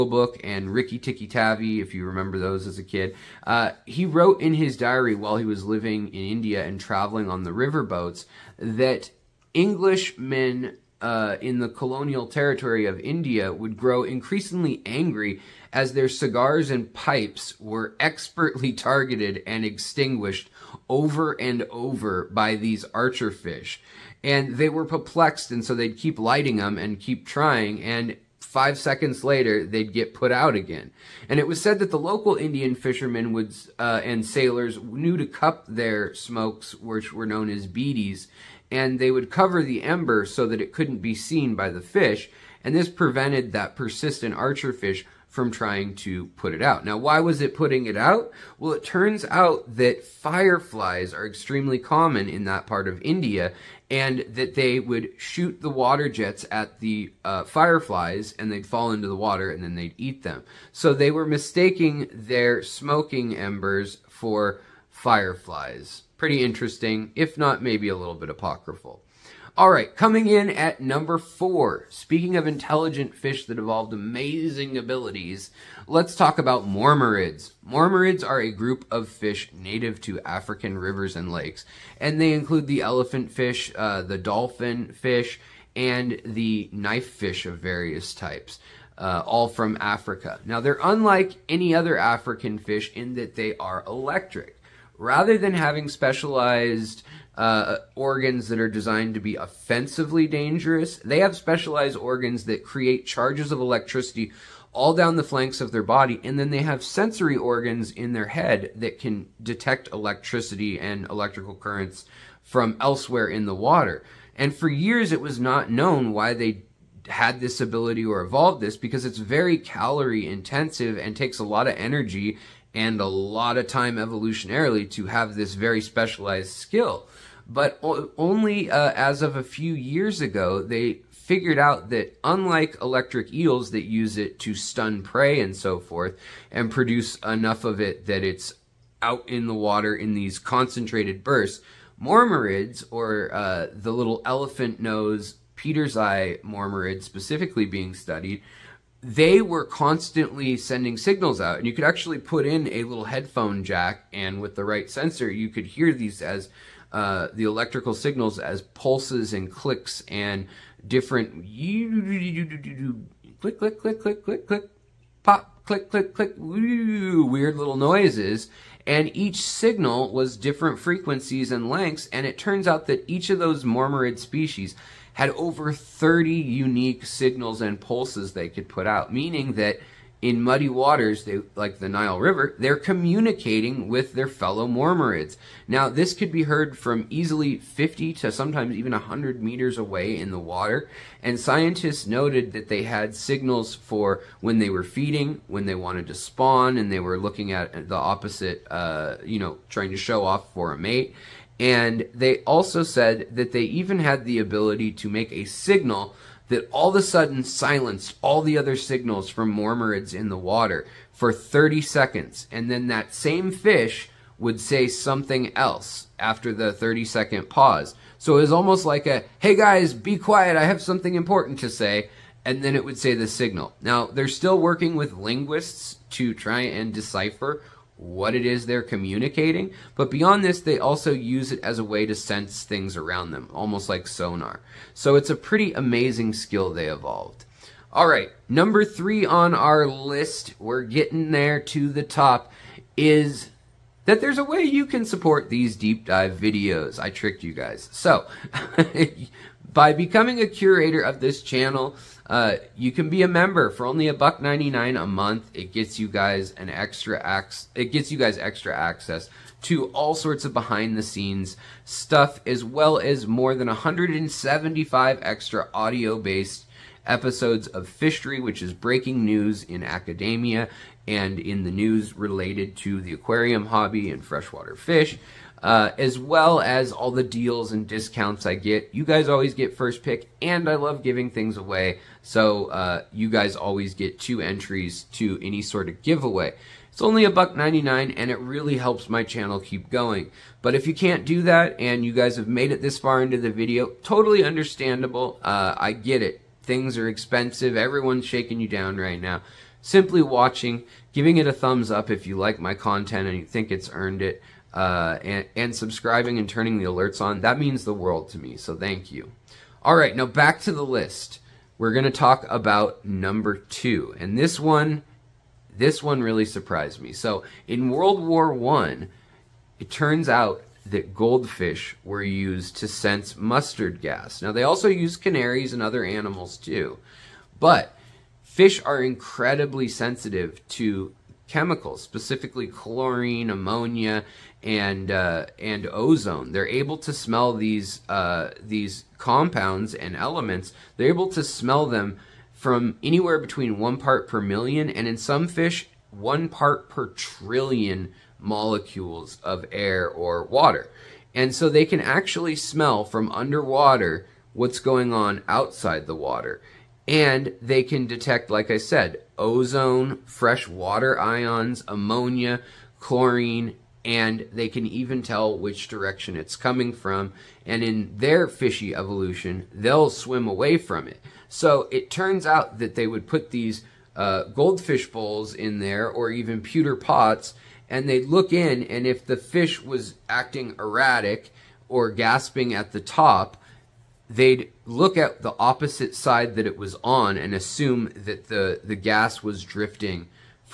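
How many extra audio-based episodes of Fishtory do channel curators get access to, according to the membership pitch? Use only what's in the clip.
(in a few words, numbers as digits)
more than 175.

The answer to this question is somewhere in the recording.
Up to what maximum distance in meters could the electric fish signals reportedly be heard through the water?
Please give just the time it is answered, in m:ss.
3:08.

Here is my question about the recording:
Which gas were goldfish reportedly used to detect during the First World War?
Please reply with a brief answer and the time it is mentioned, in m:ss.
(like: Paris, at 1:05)
mustard gas, at 5:23.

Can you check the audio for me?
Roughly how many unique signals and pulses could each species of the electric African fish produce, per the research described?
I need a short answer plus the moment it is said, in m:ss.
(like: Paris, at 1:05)
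over 30, at 2:55.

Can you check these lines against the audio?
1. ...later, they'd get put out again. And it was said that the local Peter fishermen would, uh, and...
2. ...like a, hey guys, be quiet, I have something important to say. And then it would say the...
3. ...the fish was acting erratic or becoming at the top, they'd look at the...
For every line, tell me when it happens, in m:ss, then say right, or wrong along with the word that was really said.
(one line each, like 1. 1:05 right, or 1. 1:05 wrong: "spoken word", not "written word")
1. 0:29 wrong: "Indian", not "Peter"
2. 3:38 right
3. 6:19 wrong: "gasping", not "becoming".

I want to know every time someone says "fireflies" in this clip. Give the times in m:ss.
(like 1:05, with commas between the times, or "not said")
0:50, 0:57, 1:04.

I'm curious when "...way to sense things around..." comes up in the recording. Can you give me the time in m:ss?
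3:51.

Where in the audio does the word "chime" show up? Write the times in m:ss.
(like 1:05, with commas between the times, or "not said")
not said.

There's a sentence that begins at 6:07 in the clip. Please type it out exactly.
And in their fishy evolution, they'll swim away from it.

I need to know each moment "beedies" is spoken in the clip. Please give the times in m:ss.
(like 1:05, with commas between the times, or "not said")
0:37.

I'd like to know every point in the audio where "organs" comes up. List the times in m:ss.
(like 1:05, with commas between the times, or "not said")
1:37, 1:41, 1:47.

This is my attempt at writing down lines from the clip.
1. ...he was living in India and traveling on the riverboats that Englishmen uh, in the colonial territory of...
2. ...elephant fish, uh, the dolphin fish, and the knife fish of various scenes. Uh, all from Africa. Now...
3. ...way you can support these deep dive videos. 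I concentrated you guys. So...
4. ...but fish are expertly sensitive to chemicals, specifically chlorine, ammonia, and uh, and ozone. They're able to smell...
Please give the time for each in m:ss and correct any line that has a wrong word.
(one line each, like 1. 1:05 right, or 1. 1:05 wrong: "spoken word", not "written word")
1. 0:05 right
2. 1:22 wrong: "types", not "scenes"
3. 4:04 wrong: "tricked", not "concentrated"
4. 5:27 wrong: "incredibly", not "expertly".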